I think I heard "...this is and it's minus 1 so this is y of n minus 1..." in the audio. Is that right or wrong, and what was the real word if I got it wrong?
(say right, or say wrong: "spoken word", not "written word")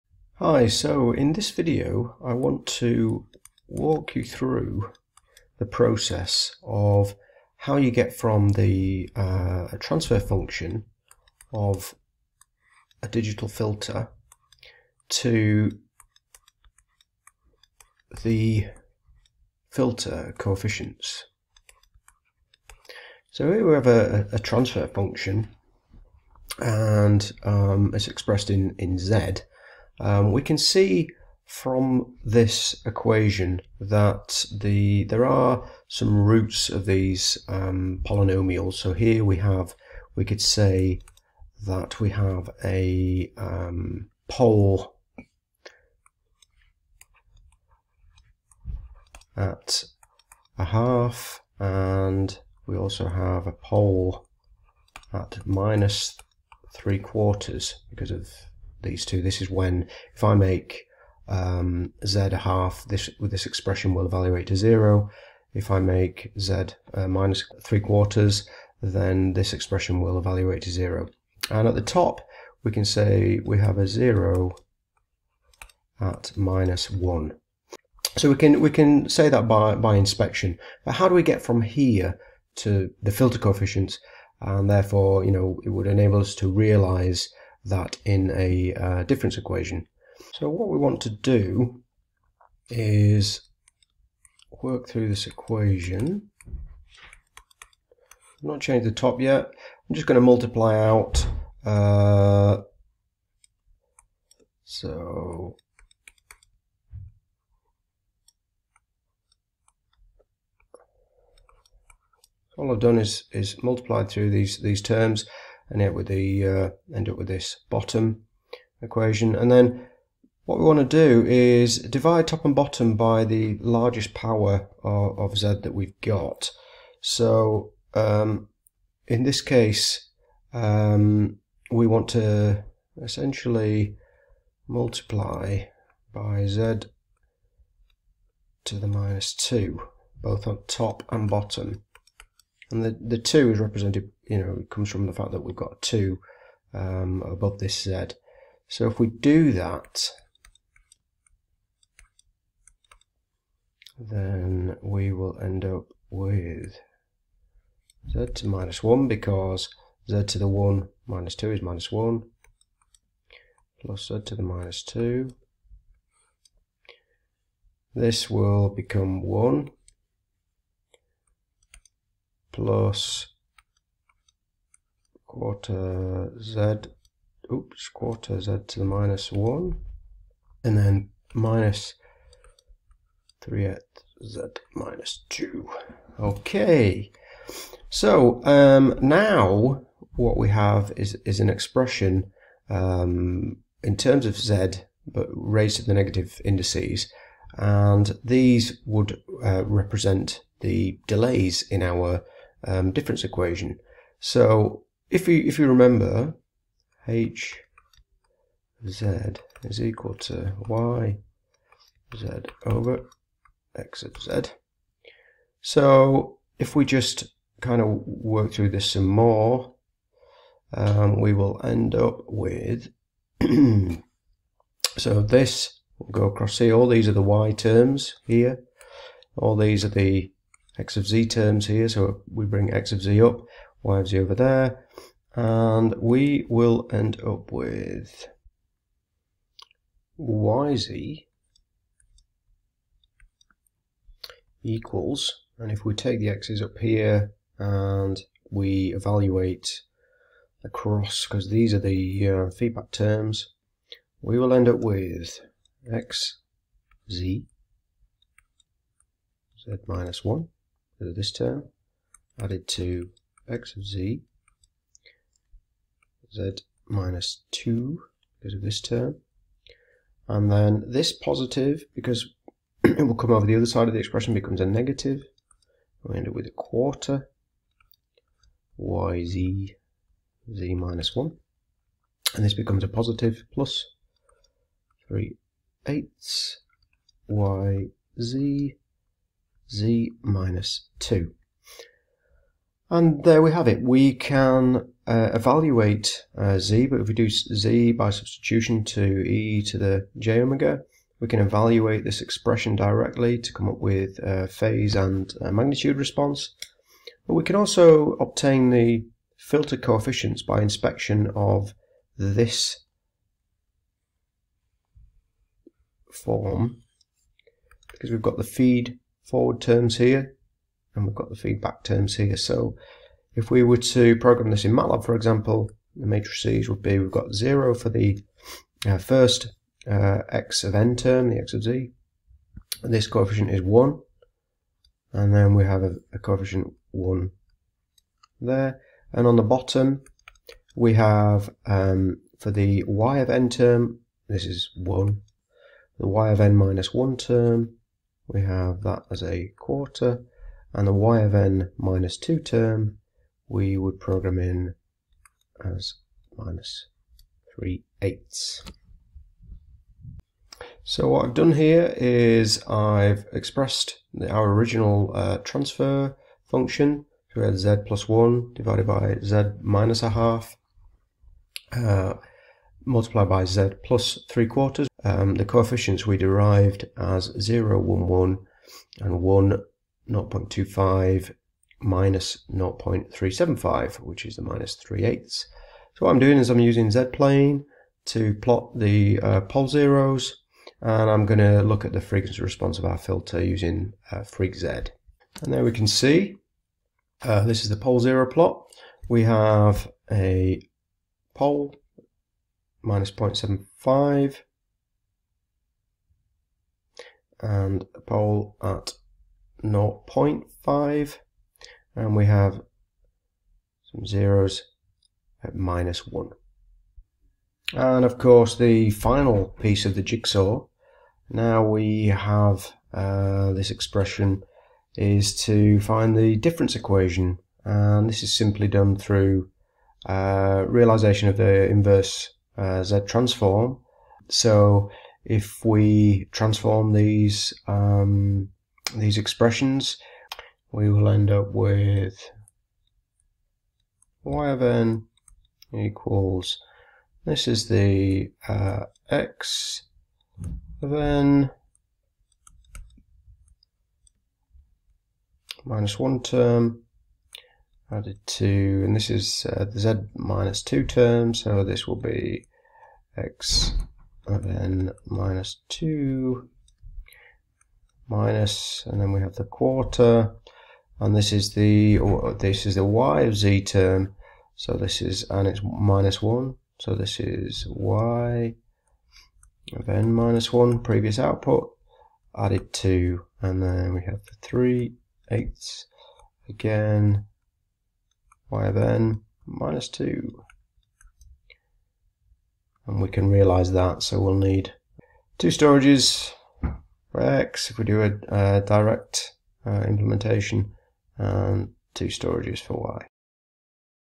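right.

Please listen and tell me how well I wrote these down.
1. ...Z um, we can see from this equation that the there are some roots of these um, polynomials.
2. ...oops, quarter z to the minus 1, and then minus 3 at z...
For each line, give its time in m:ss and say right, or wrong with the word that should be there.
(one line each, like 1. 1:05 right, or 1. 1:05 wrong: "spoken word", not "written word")
1. 0:28 right
2. 2:57 right.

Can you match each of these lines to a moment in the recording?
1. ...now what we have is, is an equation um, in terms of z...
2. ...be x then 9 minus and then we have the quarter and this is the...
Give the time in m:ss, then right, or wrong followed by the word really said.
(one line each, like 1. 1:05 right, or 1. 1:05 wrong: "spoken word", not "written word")
1. 3:09 wrong: "expression", not "equation"
2. 7:41 wrong: "2", not "9".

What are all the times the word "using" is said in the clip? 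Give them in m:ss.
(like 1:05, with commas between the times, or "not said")
6:26, 6:33.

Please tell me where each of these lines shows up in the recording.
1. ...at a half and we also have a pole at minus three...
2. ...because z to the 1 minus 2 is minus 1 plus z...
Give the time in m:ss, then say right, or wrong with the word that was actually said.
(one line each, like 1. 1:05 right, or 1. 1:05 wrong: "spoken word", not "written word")
1. 0:49 right
2. 2:39 right.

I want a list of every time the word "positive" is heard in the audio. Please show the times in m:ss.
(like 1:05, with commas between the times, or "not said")
4:31, 4:42.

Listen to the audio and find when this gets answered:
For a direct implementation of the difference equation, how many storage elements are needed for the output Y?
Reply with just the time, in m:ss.
8:21.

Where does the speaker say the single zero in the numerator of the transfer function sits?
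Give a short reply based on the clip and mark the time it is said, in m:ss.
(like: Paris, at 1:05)
-1, at 1:13.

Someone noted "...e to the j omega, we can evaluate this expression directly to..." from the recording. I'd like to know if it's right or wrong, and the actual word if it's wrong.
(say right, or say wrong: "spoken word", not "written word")
right.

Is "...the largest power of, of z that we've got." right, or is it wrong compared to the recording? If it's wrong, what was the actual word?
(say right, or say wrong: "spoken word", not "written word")
right.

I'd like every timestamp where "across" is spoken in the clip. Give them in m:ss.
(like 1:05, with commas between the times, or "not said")
3:46, 4:10.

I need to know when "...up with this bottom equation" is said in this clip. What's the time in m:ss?
1:57.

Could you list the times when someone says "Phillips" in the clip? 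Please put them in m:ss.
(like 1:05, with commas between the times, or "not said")
not said.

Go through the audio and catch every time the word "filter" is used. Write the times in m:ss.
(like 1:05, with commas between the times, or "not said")
0:13, 0:19, 1:23, 5:09, 6:32.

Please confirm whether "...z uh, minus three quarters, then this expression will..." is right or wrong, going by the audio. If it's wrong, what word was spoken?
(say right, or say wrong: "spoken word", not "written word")
right.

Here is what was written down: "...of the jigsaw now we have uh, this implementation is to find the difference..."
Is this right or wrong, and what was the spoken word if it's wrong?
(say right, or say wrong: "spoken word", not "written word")
wrong: "expression", not "implementation".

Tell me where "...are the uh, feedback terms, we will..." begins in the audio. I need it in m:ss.
4:11.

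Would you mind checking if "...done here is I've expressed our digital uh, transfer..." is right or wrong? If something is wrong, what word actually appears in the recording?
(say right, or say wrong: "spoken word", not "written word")
wrong: "original", not "digital".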